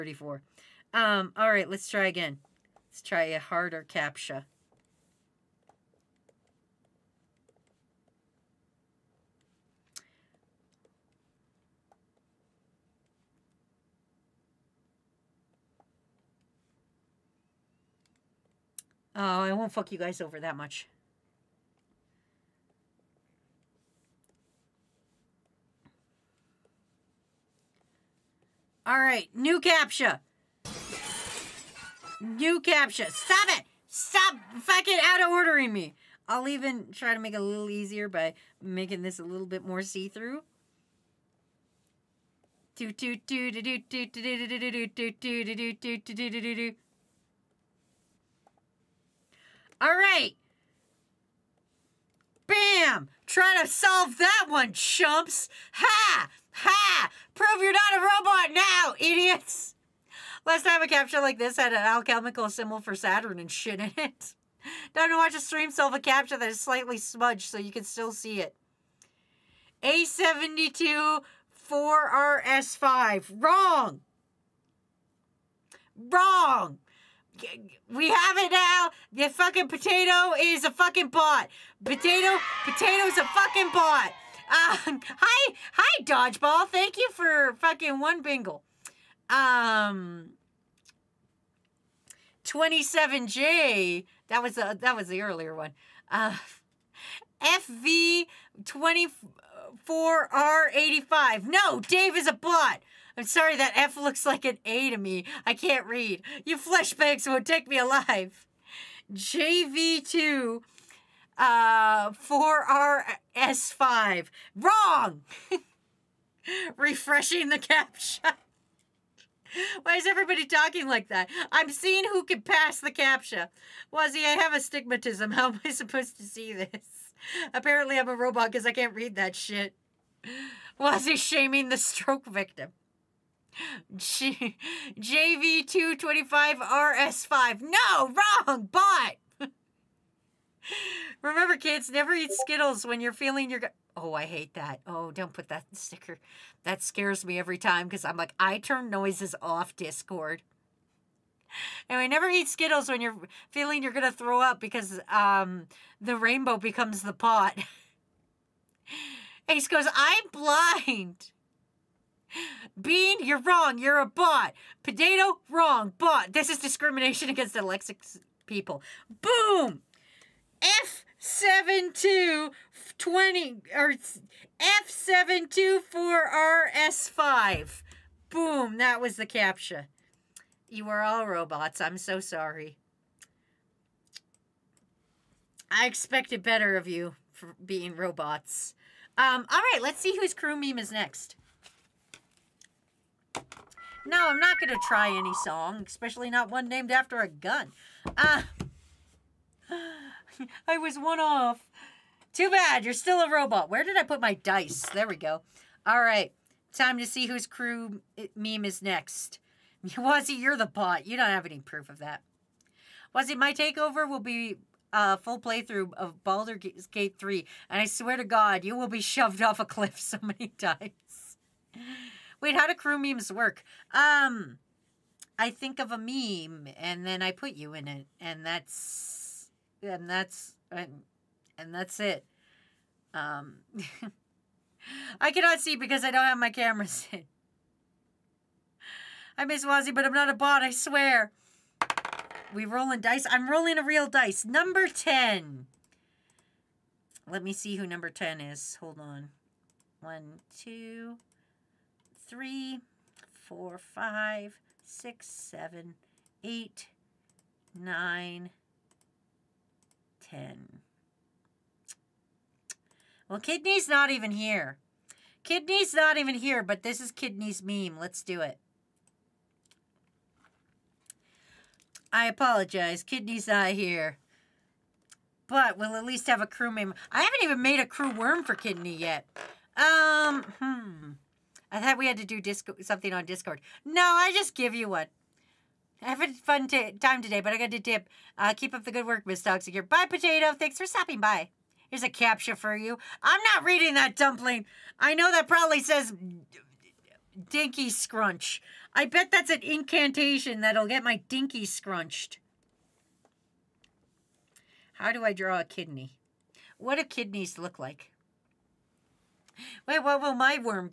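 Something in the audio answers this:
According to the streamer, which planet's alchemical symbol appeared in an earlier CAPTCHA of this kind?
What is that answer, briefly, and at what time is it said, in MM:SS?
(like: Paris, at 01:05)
Saturn, at 01:02.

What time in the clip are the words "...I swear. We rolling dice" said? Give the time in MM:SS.
04:00.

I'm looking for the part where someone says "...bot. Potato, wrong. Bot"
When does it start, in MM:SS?
02:44.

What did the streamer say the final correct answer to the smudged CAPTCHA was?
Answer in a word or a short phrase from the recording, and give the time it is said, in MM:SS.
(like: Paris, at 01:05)
F724RS5, at 02:54.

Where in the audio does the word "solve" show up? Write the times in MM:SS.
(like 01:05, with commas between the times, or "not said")
00:53, 01:05.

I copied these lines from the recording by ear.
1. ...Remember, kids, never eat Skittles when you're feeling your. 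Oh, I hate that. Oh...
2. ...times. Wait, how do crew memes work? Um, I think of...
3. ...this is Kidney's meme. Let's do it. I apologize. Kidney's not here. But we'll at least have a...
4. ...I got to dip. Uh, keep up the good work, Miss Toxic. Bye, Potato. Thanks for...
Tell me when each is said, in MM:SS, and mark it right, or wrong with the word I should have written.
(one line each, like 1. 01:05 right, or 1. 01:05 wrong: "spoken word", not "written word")
1. 02:21 right
2. 03:40 right
3. 04:26 right
4. 04:47 right.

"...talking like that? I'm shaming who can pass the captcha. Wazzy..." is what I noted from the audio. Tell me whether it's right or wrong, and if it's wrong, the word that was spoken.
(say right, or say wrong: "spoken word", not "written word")
wrong: "seeing", not "shaming".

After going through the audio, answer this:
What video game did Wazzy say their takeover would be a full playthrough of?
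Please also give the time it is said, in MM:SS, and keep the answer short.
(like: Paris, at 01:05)
Baldur's Gate 3, at 03:36.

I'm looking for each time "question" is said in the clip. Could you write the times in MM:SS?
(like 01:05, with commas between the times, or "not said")
not said.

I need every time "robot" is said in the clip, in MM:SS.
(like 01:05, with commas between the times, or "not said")
00:58, 02:08, 03:01, 03:07, 03:23.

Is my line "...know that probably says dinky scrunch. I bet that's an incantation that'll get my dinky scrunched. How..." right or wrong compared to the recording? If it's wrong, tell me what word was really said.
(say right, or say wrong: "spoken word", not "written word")
right.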